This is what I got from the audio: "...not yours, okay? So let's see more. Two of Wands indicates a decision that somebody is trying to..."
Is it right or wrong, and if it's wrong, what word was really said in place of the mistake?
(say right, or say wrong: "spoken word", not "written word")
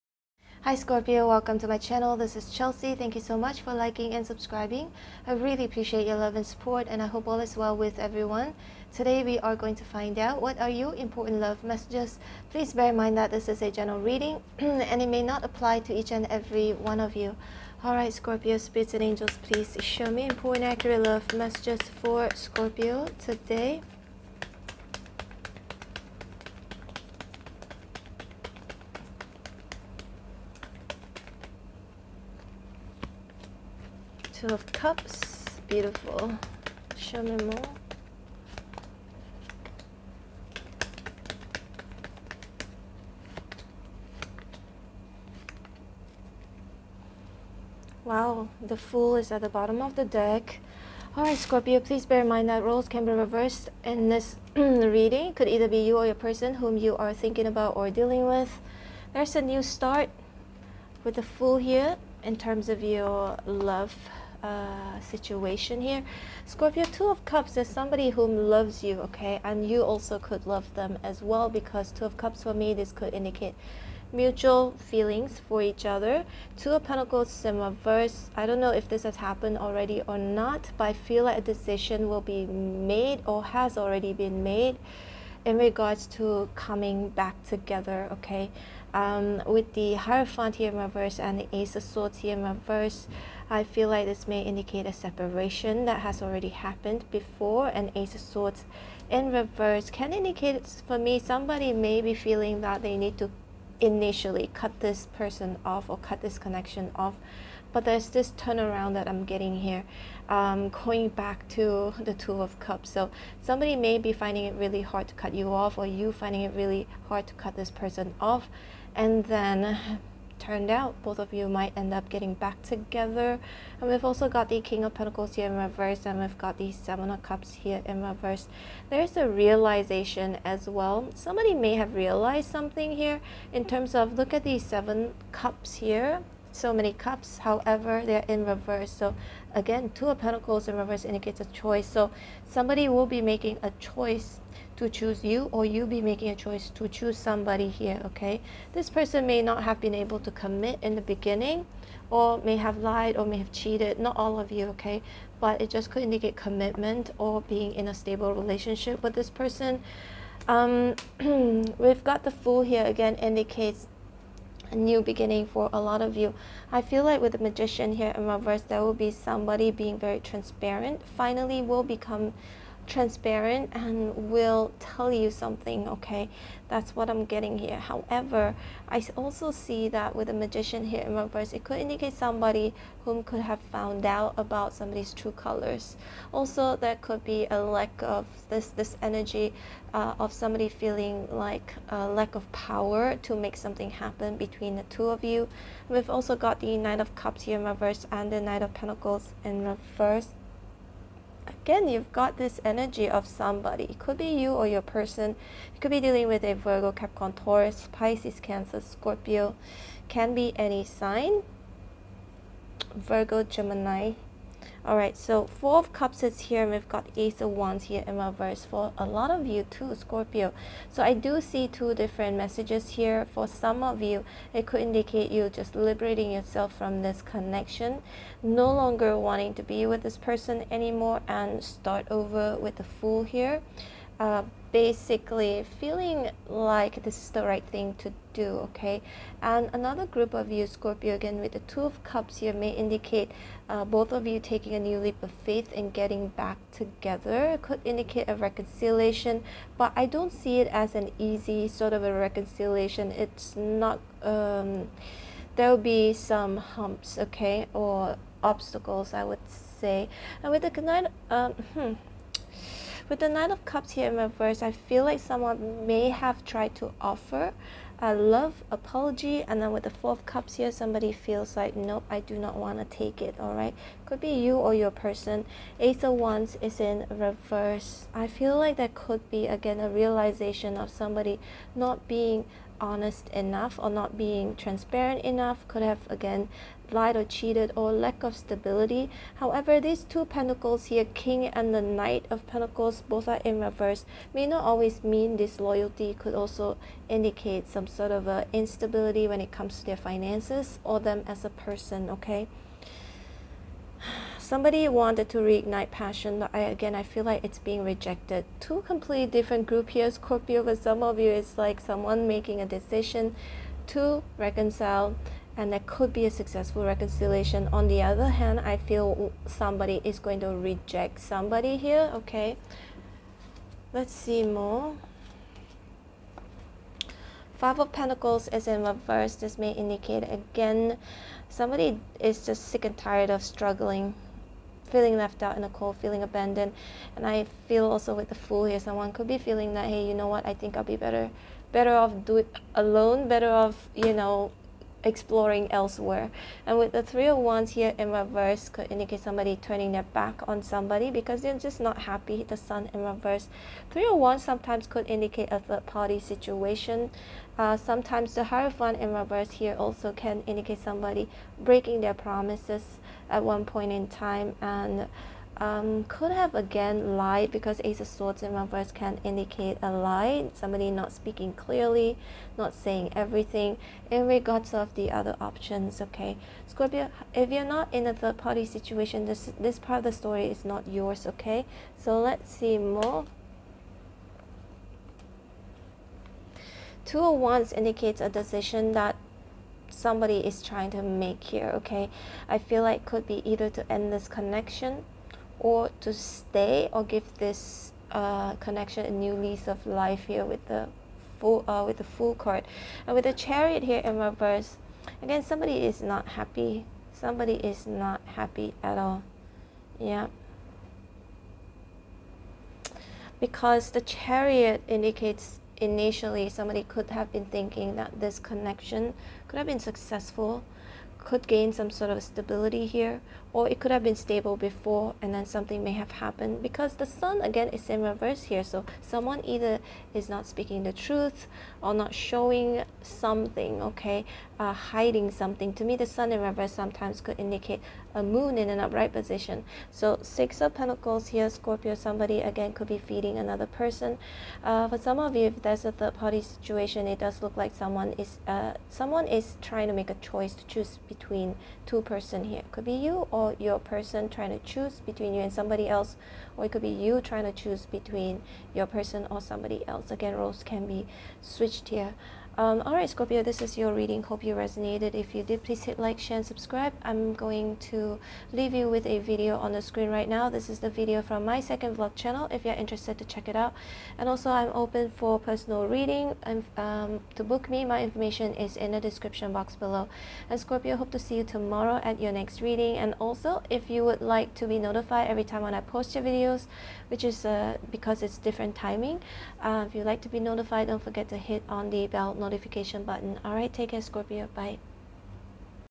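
right.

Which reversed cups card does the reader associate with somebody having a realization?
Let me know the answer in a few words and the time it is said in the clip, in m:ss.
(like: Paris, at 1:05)
Seven of Cups, at 2:06.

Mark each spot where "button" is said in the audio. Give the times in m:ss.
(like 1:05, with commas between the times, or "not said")
8:13.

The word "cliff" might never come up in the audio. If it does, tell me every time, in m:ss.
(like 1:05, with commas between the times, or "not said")
not said.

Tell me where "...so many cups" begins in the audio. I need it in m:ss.
2:16.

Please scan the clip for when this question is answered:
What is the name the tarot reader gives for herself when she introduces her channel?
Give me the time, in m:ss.
0:02.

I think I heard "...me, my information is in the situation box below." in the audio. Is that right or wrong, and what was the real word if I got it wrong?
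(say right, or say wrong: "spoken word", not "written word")
wrong: "description", not "situation".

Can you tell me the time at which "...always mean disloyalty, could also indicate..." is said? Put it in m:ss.
4:54.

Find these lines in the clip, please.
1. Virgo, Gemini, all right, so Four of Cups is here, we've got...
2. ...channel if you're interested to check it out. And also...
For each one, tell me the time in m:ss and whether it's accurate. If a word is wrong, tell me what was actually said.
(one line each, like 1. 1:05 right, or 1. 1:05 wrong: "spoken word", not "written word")
1. 3:32 right
2. 7:52 right.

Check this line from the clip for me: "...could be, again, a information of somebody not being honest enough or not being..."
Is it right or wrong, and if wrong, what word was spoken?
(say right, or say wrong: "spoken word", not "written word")
wrong: "realization", not "information".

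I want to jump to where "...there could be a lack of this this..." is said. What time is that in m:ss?
3:06.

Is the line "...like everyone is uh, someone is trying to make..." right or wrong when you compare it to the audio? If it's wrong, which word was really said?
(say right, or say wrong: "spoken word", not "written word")
wrong: "someone", not "everyone".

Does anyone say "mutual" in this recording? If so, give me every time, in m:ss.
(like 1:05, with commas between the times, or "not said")
1:14.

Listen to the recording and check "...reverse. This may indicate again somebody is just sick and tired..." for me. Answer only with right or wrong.
right.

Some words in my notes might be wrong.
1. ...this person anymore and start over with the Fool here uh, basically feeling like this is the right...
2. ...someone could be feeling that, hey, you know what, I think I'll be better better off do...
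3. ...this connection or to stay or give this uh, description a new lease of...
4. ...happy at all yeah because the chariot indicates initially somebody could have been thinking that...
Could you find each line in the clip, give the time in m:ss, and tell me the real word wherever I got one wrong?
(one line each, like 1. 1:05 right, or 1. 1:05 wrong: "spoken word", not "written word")
1. 3:50 right
2. 5:38 right
3. 6:34 wrong: "connection", not "description"
4. 6:48 right.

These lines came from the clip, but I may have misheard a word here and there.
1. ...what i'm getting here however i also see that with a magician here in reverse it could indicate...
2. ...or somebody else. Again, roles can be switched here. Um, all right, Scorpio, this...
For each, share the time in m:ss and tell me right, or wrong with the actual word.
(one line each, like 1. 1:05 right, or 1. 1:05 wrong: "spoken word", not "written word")
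1. 2:56 right
2. 7:39 right.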